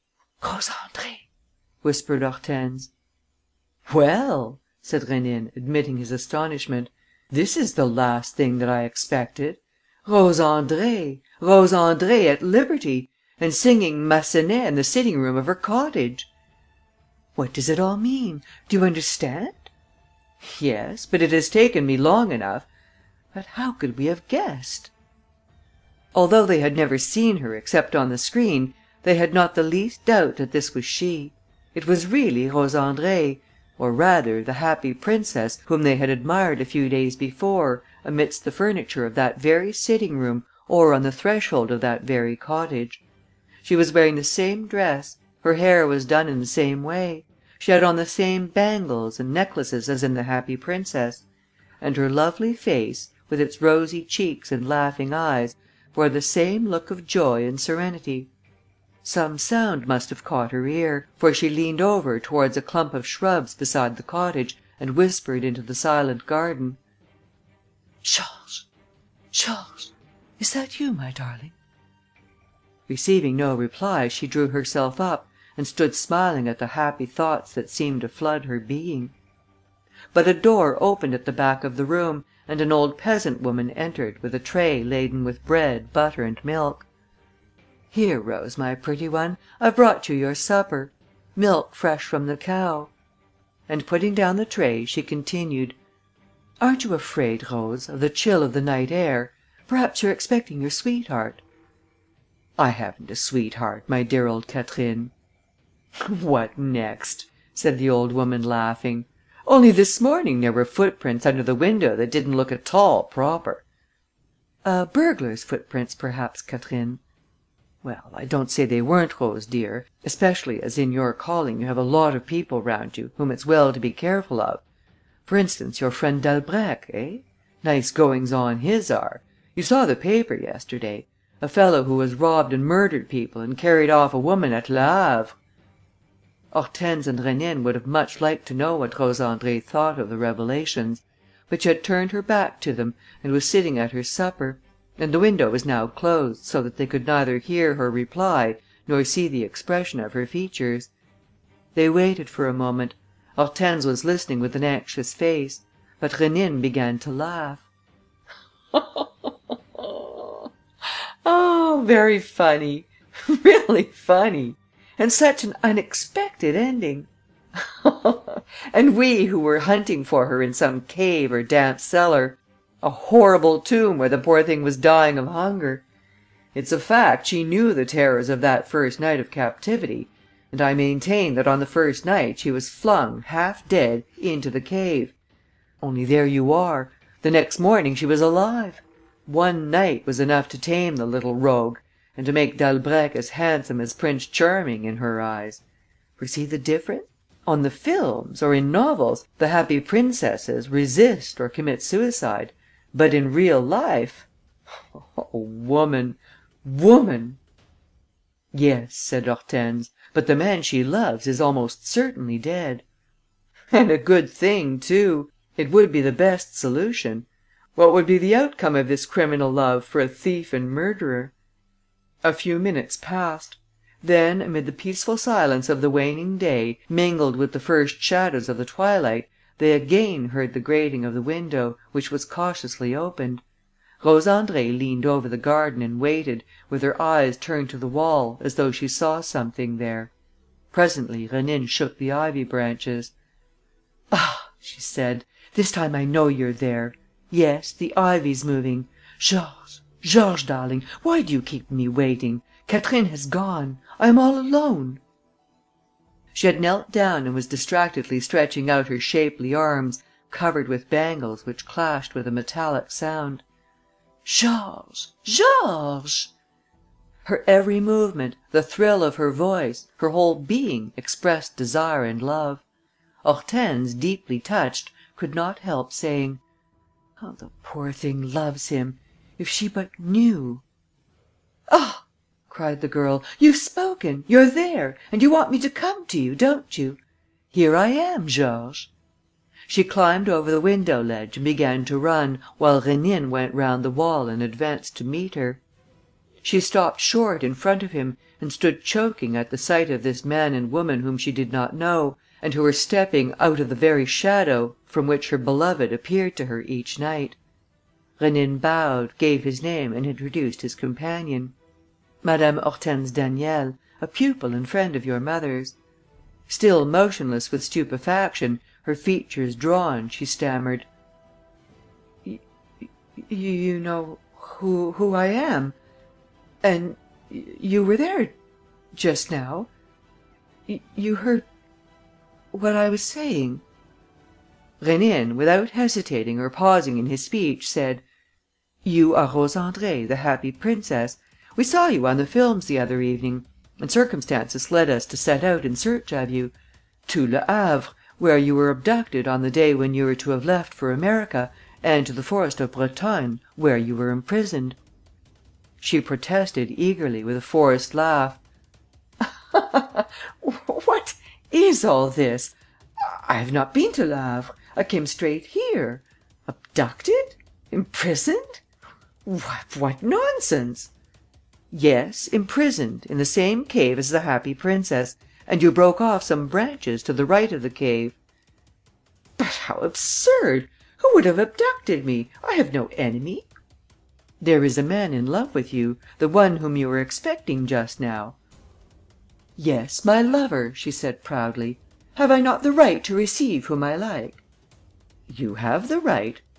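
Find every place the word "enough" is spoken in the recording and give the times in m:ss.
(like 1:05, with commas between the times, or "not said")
0:22, 3:10.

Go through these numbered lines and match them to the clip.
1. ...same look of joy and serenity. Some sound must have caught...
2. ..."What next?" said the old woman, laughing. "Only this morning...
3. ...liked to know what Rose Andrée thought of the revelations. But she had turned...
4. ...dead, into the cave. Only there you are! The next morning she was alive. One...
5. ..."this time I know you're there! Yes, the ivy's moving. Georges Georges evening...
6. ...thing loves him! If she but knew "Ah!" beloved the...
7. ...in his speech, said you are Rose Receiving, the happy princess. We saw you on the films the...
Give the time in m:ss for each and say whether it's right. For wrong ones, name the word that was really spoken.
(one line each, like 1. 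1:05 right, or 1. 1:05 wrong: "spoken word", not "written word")
1. 0:56 right
2. 1:46 right
3. 2:18 right
4. 3:03 right
5. 4:05 wrong: "darling", not "evening"
6. 4:37 wrong: "cried", not "beloved"
7. 5:36 wrong: "Andrée", not "Receiving".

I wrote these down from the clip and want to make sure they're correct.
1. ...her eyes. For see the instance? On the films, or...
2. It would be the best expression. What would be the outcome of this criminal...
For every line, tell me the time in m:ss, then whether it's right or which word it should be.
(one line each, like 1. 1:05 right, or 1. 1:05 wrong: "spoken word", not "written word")
1. 3:14 wrong: "difference", not "instance"
2. 3:35 wrong: "solution", not "expression".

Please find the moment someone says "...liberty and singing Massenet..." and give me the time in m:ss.
0:12.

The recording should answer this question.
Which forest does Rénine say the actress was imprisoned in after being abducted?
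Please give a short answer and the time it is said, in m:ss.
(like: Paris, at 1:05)
Brotonne, at 5:52.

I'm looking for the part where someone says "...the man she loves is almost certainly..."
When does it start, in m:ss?
3:30.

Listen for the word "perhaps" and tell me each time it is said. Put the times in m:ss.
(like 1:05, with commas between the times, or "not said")
1:39, 1:55.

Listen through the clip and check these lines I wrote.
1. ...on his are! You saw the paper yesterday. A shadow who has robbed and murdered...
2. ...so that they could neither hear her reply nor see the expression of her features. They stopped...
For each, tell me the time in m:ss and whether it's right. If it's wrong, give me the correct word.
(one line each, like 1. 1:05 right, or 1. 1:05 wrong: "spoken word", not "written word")
1. 2:08 wrong: "fellow", not "shadow"
2. 2:26 wrong: "waited", not "stopped".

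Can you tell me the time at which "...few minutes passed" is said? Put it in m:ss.
3:42.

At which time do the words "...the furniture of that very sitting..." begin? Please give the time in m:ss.
0:38.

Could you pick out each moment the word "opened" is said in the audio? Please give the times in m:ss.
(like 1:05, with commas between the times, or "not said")
1:20, 3:52.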